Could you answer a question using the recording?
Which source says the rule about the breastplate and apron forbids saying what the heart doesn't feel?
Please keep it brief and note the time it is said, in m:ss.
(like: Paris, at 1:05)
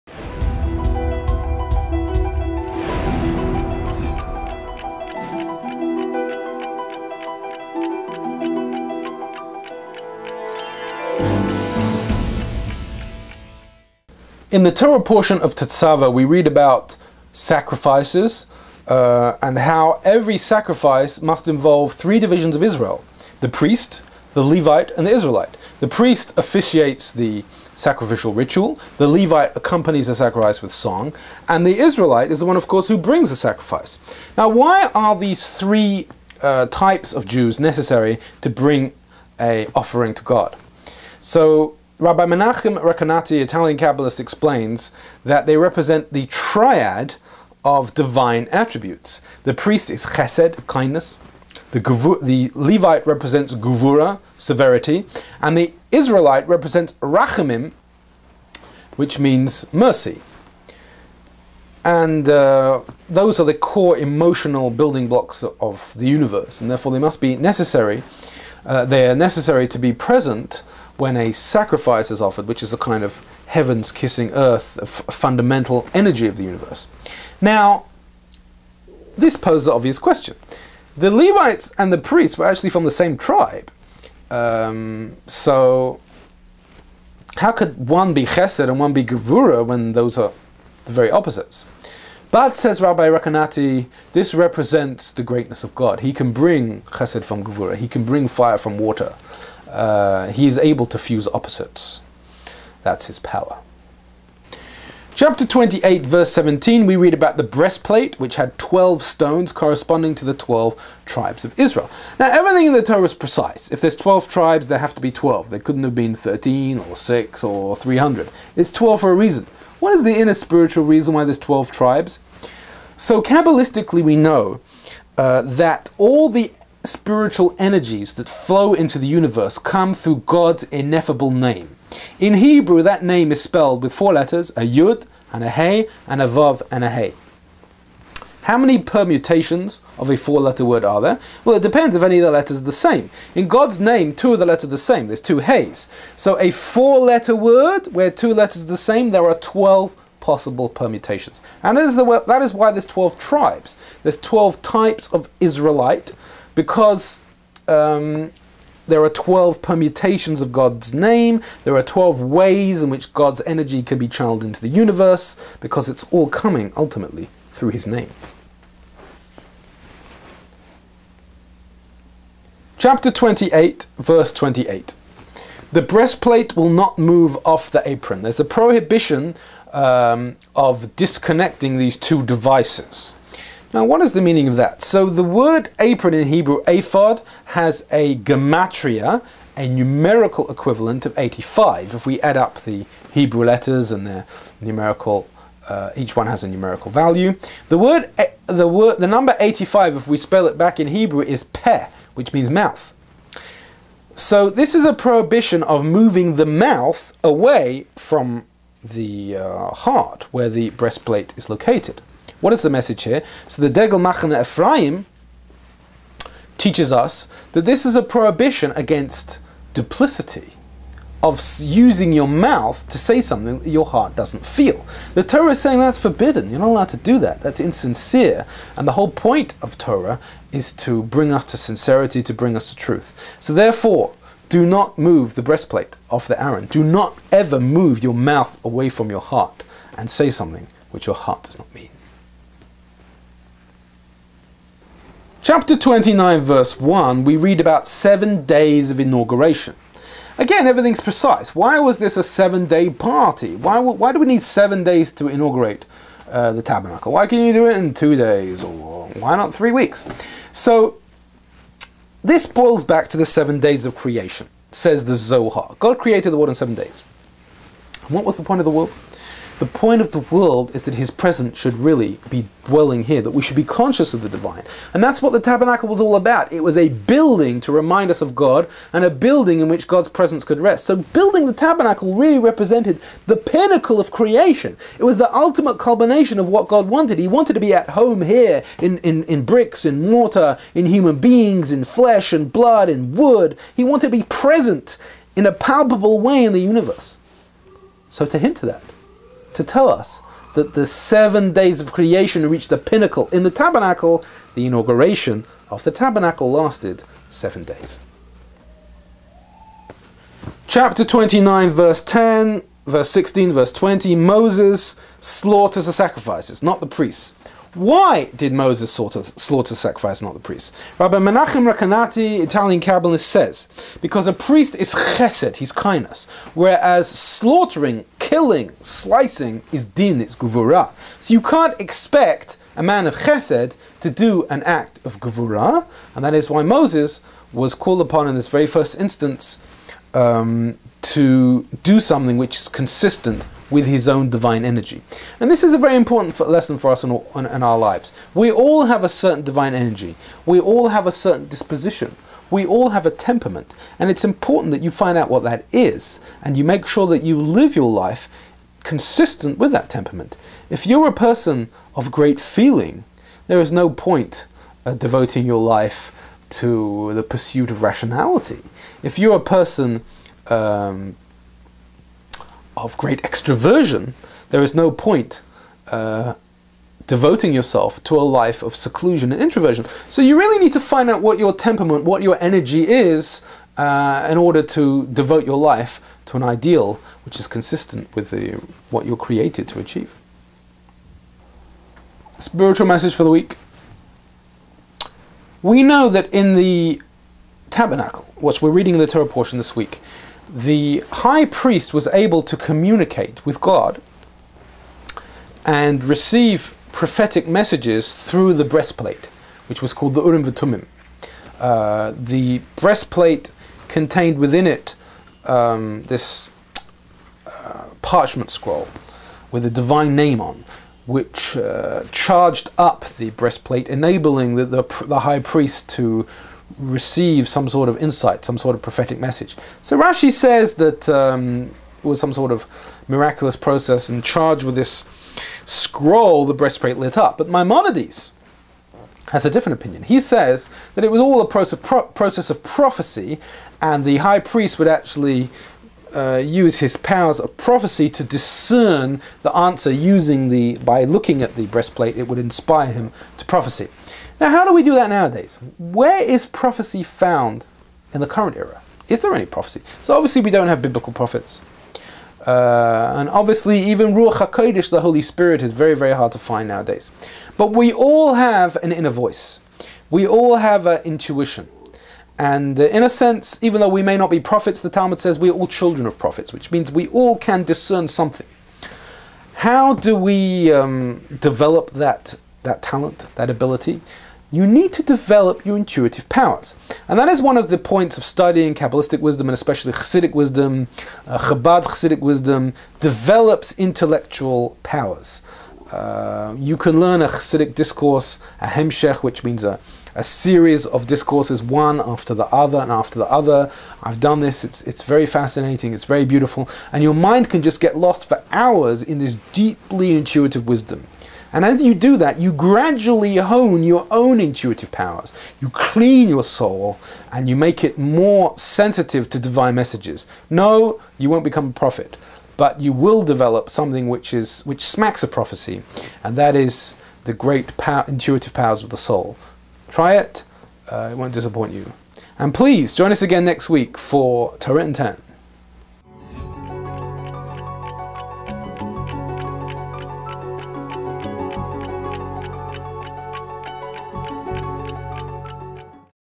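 Degel Machane Ephraim, at 3:33.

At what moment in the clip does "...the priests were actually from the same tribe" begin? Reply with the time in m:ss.
1:21.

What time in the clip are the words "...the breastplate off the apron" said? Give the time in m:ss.
3:55.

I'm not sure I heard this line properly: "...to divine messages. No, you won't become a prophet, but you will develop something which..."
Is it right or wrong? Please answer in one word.
right.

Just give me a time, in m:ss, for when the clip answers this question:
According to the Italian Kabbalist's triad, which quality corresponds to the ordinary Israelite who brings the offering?
0:57.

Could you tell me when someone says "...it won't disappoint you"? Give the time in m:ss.
8:51.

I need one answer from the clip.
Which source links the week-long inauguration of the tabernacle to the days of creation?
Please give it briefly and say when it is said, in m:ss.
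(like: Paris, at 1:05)
the Zohar, at 4:25.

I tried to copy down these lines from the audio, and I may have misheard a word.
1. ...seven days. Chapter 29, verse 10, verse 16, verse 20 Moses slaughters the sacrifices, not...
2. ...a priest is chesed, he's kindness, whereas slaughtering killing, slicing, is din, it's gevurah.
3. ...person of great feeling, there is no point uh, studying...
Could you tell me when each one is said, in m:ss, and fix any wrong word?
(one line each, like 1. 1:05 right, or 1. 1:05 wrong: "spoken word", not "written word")
1. 5:07 right
2. 5:24 right
3. 6:01 wrong: "devoting", not "studying".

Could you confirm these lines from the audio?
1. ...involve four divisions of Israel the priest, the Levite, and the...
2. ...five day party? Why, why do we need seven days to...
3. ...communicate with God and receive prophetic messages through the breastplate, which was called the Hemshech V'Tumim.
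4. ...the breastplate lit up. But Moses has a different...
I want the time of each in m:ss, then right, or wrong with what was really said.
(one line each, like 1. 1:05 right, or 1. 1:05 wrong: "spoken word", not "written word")
1. 0:21 wrong: "three", not "four"
2. 4:12 wrong: "seven", not "five"
3. 6:42 wrong: "Urim", not "Hemshech"
4. 7:16 wrong: "Maimonides", not "Moses".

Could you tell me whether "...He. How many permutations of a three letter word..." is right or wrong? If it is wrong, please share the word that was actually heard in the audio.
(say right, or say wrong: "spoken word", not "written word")
wrong: "four", not "three".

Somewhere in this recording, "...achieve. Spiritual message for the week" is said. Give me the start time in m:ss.
6:29.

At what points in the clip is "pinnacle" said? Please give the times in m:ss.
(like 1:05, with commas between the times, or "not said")
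4:43, 5:02.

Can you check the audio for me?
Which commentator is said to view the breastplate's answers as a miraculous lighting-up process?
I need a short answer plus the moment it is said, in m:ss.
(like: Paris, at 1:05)
Rashi, at 7:09.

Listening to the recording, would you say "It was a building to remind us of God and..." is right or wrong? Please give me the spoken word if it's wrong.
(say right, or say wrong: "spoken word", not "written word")
right.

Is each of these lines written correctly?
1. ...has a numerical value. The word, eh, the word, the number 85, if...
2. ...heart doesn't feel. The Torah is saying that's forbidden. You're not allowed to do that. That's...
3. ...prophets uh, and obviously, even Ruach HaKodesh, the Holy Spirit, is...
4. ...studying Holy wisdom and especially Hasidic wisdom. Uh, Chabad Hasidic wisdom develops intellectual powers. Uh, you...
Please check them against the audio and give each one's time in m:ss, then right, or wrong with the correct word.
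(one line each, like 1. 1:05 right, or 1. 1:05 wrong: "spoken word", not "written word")
1. 3:16 right
2. 3:43 right
3. 7:41 right
4. 8:08 wrong: "Kabbalistic", not "Holy".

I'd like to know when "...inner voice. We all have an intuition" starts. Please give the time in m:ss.
7:48.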